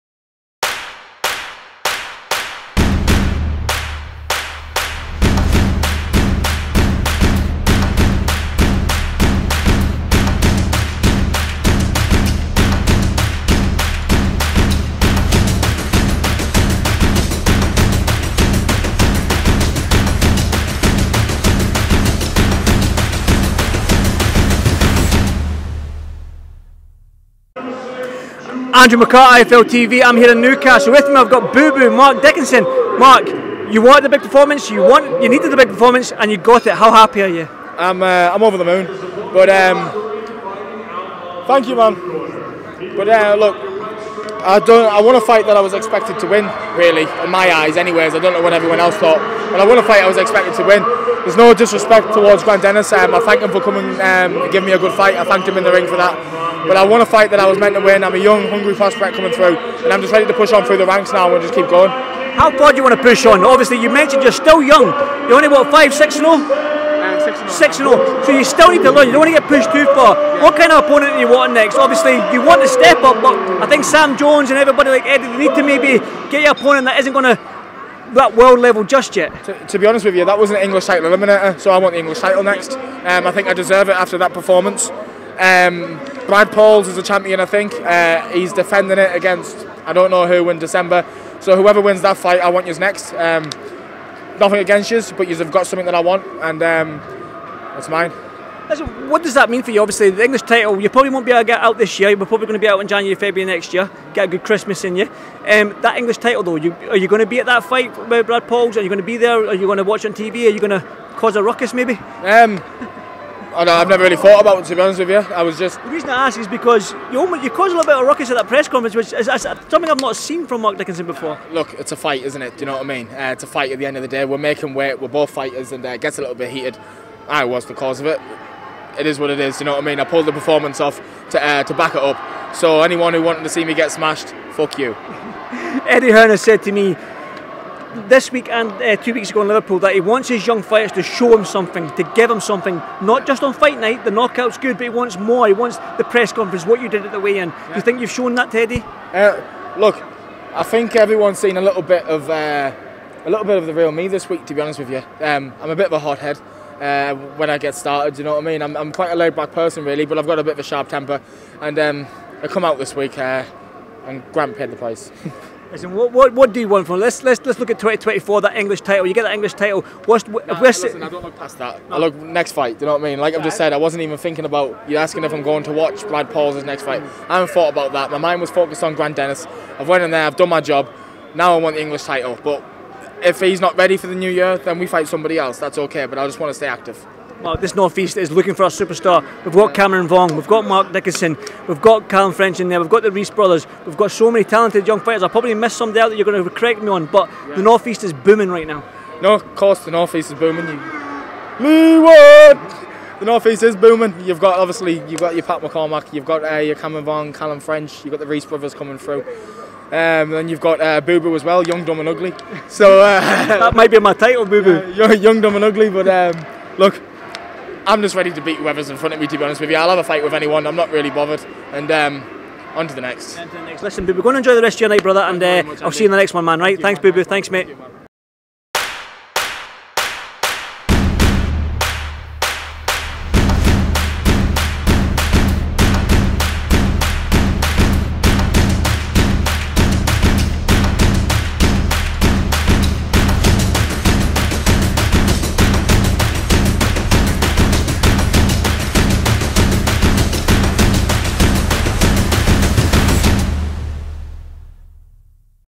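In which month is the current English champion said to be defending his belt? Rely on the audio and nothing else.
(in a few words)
December.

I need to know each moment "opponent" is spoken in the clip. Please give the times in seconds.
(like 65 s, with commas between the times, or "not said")
70 s, 76 s.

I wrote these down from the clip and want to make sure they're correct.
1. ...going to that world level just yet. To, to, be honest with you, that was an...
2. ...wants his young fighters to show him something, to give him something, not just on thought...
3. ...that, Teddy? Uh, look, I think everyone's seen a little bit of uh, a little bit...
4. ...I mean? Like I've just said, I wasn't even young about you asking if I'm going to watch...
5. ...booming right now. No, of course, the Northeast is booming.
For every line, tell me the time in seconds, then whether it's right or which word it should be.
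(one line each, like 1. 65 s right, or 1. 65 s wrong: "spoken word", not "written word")
1. 77 s right
2. 140 s wrong: "fight", not "thought"
3. 148 s right
4. 173 s wrong: "thinking", not "young"
5. 198 s right.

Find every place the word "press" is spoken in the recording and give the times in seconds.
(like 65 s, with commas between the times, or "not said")
118 s, 146 s.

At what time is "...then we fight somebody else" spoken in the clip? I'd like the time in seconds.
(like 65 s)
184 s.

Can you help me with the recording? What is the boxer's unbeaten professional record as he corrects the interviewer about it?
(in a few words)
6-0.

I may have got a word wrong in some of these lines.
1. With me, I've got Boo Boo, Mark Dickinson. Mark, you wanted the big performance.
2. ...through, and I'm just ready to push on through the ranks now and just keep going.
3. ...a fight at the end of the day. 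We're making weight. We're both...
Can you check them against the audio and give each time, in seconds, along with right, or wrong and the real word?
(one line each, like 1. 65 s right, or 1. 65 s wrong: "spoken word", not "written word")
1. 30 s right
2. 59 s right
3. 123 s right.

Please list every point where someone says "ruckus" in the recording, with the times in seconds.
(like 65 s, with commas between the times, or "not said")
111 s, 118 s.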